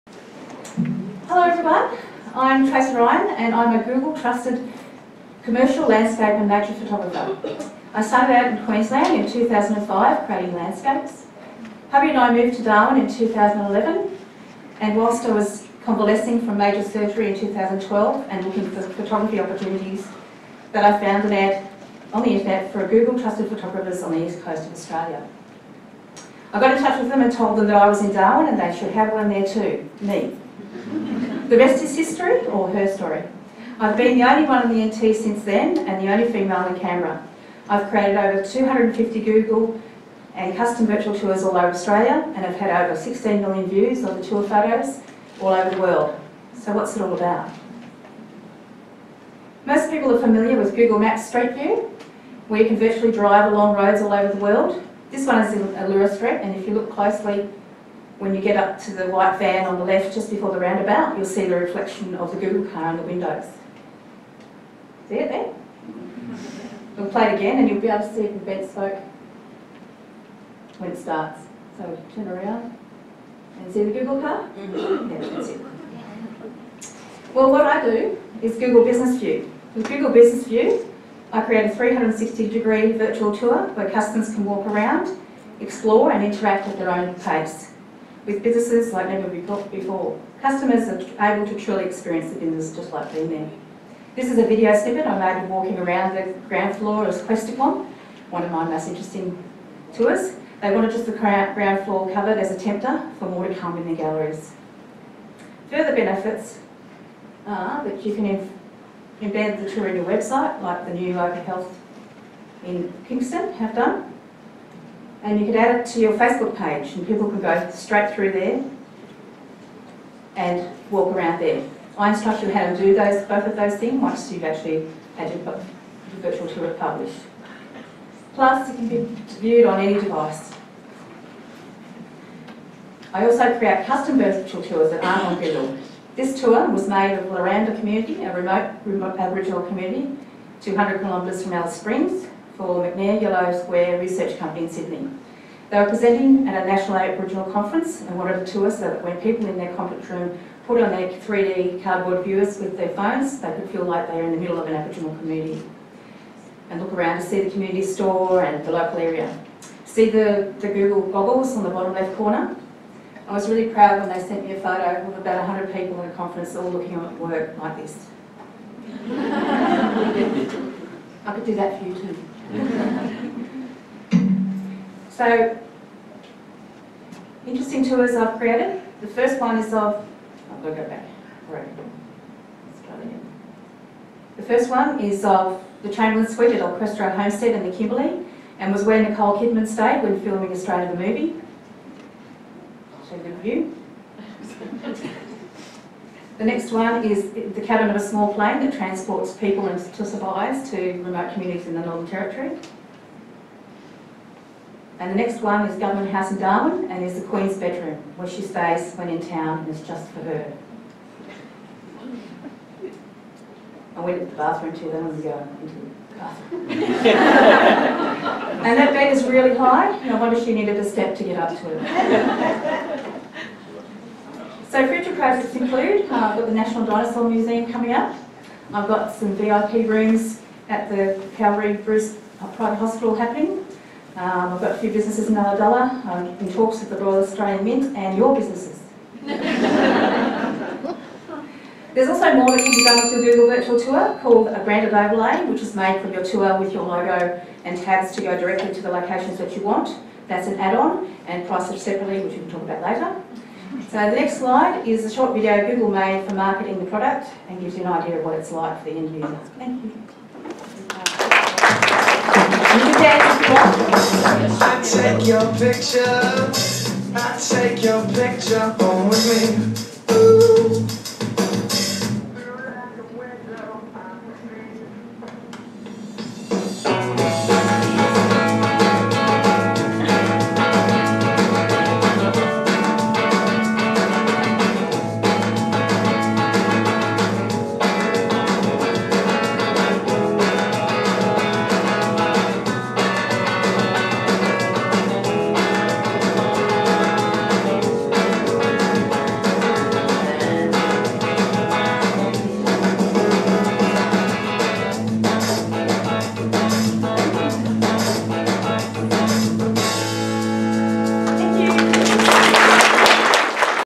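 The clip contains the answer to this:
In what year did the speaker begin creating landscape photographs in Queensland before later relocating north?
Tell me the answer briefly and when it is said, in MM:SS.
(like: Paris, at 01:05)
2005, at 00:09.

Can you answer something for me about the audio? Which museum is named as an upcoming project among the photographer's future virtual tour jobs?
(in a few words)
National Dinosaur Museum.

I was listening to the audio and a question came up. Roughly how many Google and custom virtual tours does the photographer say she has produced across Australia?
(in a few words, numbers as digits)
Over 250.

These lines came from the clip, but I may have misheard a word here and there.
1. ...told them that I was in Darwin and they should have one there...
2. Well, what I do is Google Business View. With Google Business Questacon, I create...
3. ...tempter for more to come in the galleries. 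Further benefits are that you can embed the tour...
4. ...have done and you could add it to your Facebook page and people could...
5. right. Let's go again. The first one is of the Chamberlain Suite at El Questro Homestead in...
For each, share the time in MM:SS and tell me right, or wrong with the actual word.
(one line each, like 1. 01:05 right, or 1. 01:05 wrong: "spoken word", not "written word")
1. 00:27 right
2. 01:17 wrong: "View", not "Questacon"
3. 01:42 right
4. 01:53 right
5. 03:01 right.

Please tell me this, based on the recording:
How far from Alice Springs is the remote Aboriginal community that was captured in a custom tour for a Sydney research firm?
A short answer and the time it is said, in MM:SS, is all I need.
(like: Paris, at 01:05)
200 kilometres, at 02:20.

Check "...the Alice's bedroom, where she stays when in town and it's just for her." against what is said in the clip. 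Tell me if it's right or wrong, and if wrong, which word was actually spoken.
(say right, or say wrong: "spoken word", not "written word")
wrong: "Queen", not "Alice".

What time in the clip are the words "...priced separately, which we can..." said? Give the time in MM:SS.
04:11.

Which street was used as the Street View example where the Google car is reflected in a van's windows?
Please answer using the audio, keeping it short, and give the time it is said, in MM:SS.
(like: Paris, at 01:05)
Allura Street, at 00:55.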